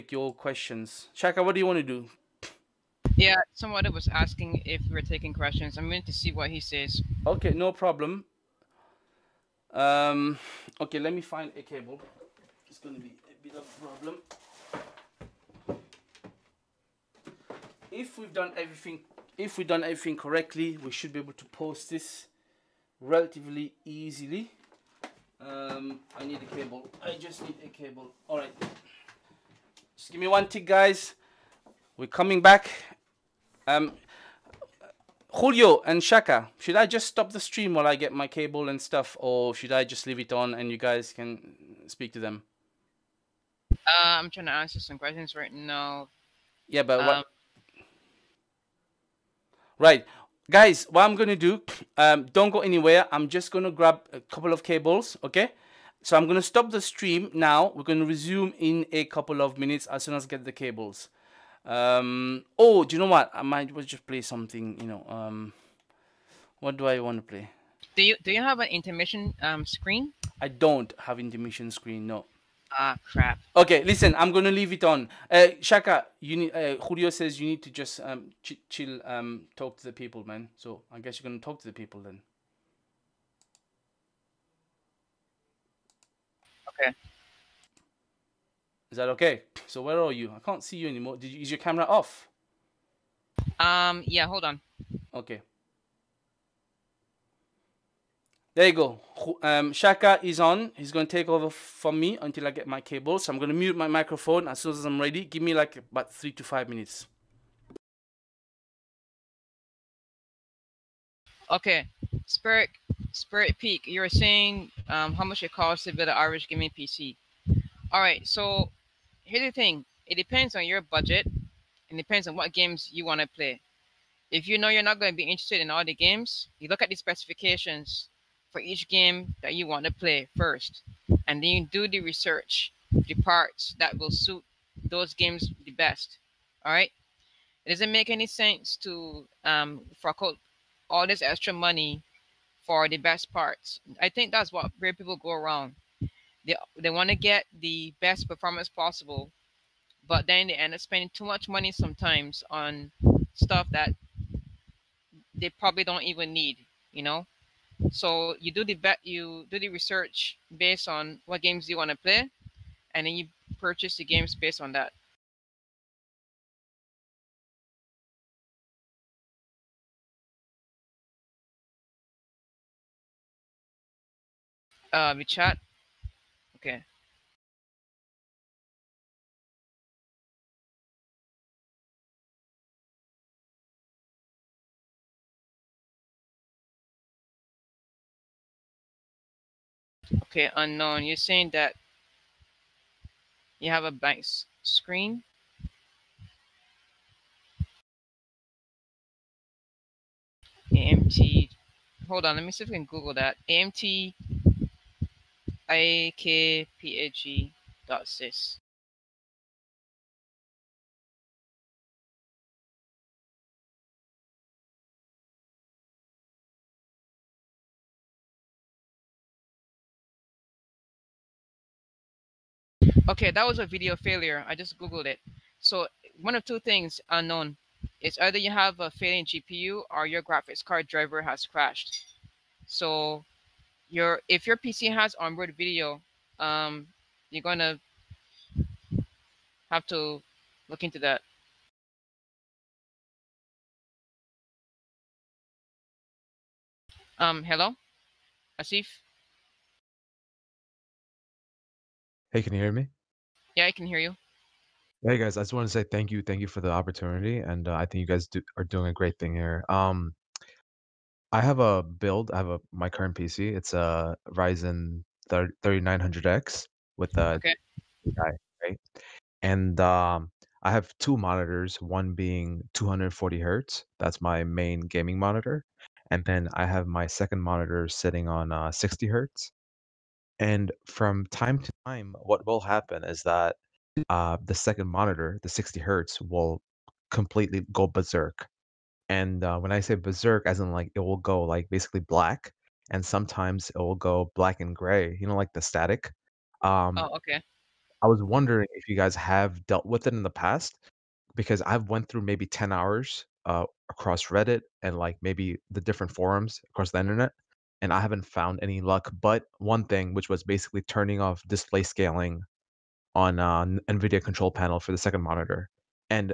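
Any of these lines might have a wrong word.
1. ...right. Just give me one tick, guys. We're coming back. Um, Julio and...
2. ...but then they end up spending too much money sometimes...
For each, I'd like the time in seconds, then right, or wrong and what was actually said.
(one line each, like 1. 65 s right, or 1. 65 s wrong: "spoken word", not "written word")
1. 28 s right
2. 150 s right.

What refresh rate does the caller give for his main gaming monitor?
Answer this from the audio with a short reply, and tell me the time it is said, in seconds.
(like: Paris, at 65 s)
240 hertz, at 272 s.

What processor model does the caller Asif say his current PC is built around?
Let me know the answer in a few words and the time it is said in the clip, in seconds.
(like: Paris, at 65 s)
Ryzen 3900X, at 264 s.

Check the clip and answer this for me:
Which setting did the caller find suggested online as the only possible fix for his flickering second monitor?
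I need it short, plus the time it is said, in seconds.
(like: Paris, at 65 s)
Display scaling, at 311 s.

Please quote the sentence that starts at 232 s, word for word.
So your if your PC has onboard video, um, you're gonna have to look into that.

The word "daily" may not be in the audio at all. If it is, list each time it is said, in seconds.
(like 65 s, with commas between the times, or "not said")
not said.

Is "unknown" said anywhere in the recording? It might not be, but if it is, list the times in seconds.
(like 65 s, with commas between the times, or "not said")
190 s, 227 s.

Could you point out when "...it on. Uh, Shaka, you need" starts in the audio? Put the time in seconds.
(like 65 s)
74 s.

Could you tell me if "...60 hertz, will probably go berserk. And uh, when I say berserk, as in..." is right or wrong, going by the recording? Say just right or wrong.
wrong.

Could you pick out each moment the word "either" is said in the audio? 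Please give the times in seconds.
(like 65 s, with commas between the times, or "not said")
228 s.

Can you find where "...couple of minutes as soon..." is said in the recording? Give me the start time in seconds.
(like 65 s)
59 s.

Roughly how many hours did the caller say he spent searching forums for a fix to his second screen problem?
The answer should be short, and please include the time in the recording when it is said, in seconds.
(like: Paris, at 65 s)
10, at 302 s.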